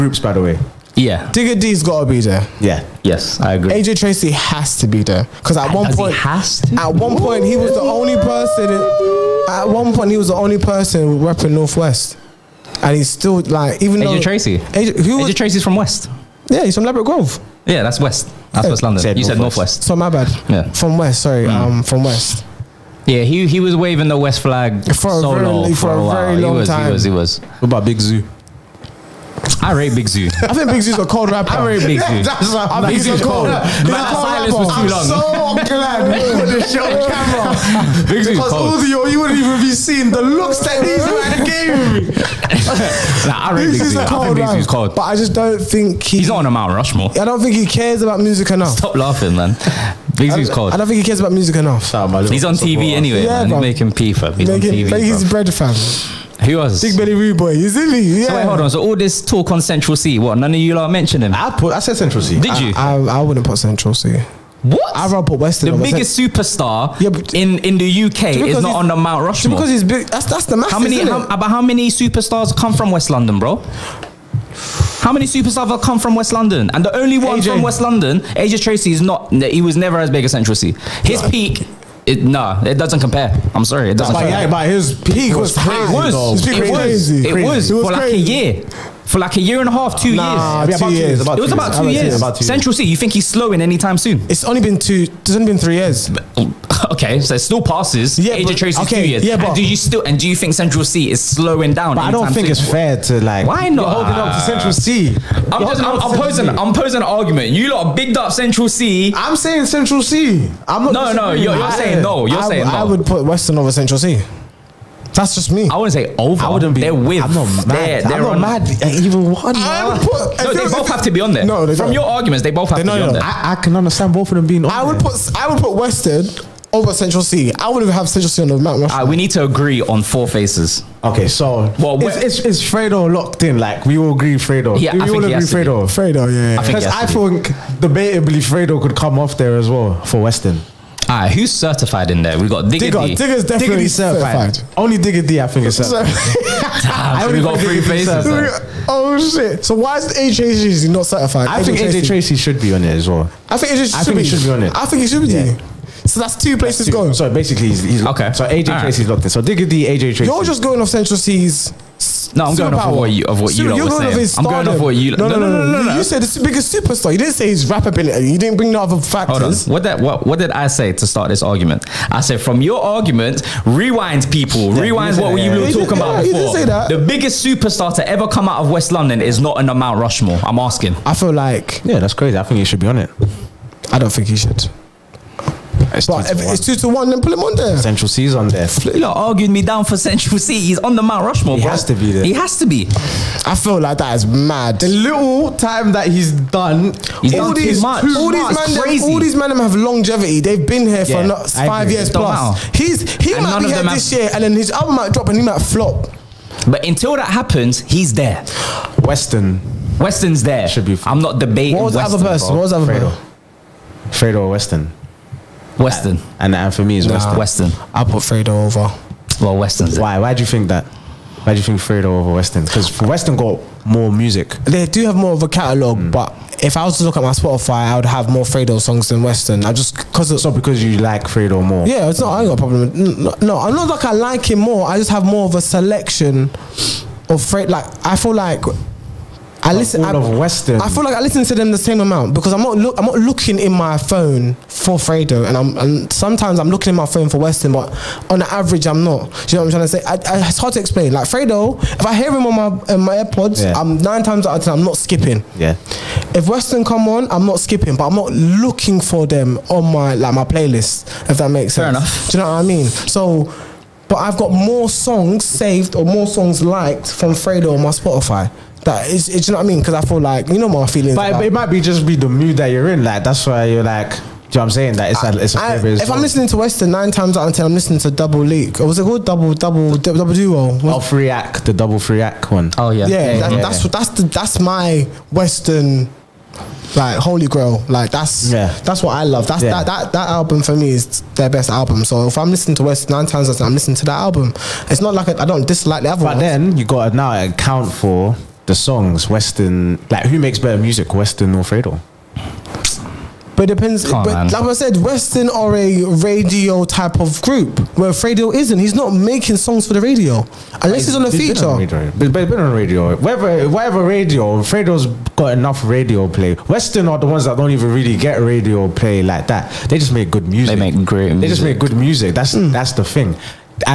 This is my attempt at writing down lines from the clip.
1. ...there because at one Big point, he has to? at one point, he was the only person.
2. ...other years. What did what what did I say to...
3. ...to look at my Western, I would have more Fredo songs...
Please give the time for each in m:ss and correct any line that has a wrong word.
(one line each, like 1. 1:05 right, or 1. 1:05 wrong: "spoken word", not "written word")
1. 0:05 wrong: "Does", not "Big"
2. 2:48 wrong: "factors", not "years"
3. 3:46 wrong: "Spotify", not "Western".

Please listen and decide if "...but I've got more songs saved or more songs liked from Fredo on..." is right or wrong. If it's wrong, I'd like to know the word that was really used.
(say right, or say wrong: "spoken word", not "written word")
right.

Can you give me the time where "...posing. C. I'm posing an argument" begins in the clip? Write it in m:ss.
1:46.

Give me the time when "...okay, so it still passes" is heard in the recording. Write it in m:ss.
1:36.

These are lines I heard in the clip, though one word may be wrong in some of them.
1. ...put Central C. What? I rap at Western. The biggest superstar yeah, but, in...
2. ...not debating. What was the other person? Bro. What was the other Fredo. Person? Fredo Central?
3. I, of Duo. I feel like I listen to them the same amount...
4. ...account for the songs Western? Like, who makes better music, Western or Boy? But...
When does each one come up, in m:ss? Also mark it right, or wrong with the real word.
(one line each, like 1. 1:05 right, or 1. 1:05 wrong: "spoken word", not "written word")
1. 1:03 right
2. 3:31 wrong: "Western", not "Central"
3. 4:00 wrong: "Western", not "Duo"
4. 4:57 wrong: "Fredo", not "Boy".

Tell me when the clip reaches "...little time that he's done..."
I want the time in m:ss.
3:14.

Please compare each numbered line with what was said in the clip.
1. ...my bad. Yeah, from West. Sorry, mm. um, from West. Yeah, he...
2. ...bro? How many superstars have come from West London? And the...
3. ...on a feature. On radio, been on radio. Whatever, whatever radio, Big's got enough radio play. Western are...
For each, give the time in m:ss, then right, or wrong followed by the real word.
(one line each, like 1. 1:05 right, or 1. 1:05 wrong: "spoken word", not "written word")
1. 0:19 right
2. 1:13 right
3. 5:11 wrong: "Fredo", not "Big".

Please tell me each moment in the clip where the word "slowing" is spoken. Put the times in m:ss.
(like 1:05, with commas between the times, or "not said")
1:33, 1:41.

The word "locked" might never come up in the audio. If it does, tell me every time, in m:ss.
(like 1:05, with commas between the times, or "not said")
2:13, 2:39.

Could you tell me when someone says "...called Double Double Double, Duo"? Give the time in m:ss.
4:39.